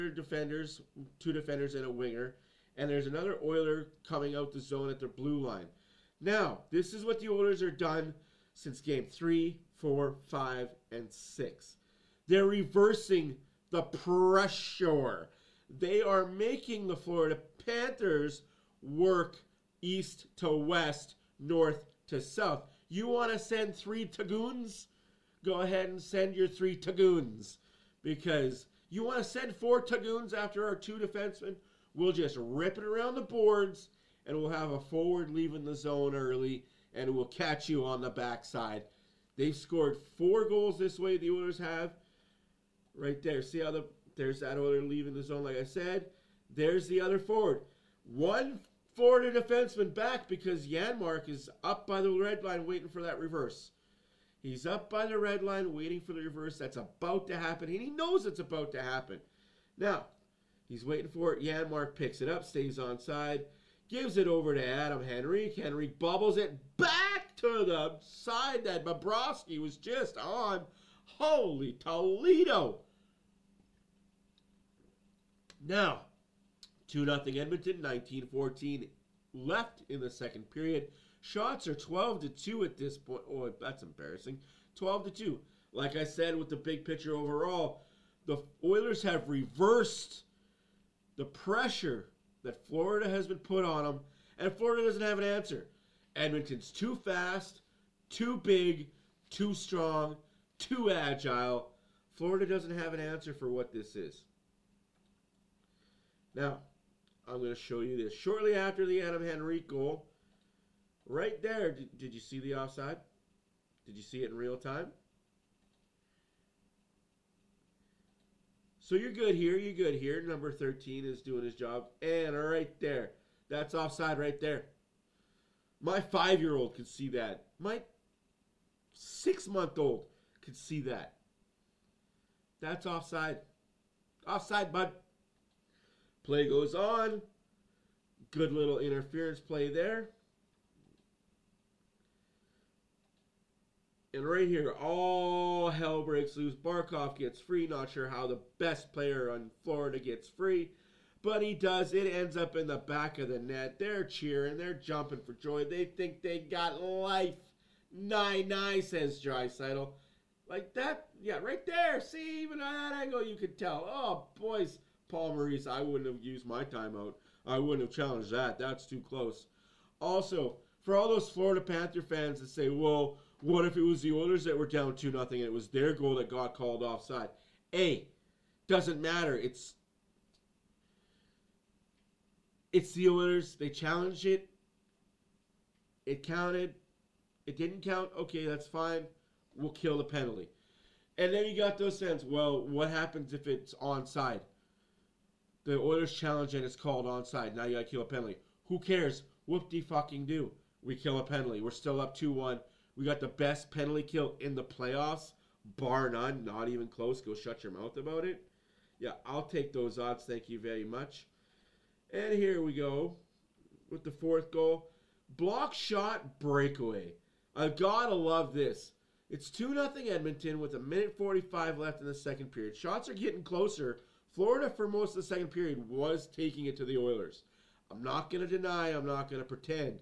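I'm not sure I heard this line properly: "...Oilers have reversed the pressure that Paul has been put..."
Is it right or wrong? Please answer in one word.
wrong.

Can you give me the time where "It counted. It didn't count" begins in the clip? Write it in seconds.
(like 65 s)
186 s.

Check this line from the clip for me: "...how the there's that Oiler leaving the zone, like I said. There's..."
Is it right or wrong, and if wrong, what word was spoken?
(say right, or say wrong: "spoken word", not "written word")
right.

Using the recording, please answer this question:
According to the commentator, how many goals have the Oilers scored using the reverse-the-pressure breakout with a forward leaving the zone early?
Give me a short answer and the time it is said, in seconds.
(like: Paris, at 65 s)
4, at 40 s.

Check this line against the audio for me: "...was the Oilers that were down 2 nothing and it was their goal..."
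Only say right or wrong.
right.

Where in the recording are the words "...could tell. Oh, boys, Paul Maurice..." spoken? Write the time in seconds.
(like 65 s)
163 s.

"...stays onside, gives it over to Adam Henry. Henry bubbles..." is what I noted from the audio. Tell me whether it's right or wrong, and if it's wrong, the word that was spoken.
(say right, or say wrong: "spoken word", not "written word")
right.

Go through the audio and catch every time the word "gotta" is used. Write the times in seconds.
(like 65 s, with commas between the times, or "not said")
197 s, 217 s.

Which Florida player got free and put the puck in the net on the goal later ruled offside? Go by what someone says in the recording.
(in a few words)
Barkov.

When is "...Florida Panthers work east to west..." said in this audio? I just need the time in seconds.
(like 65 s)
16 s.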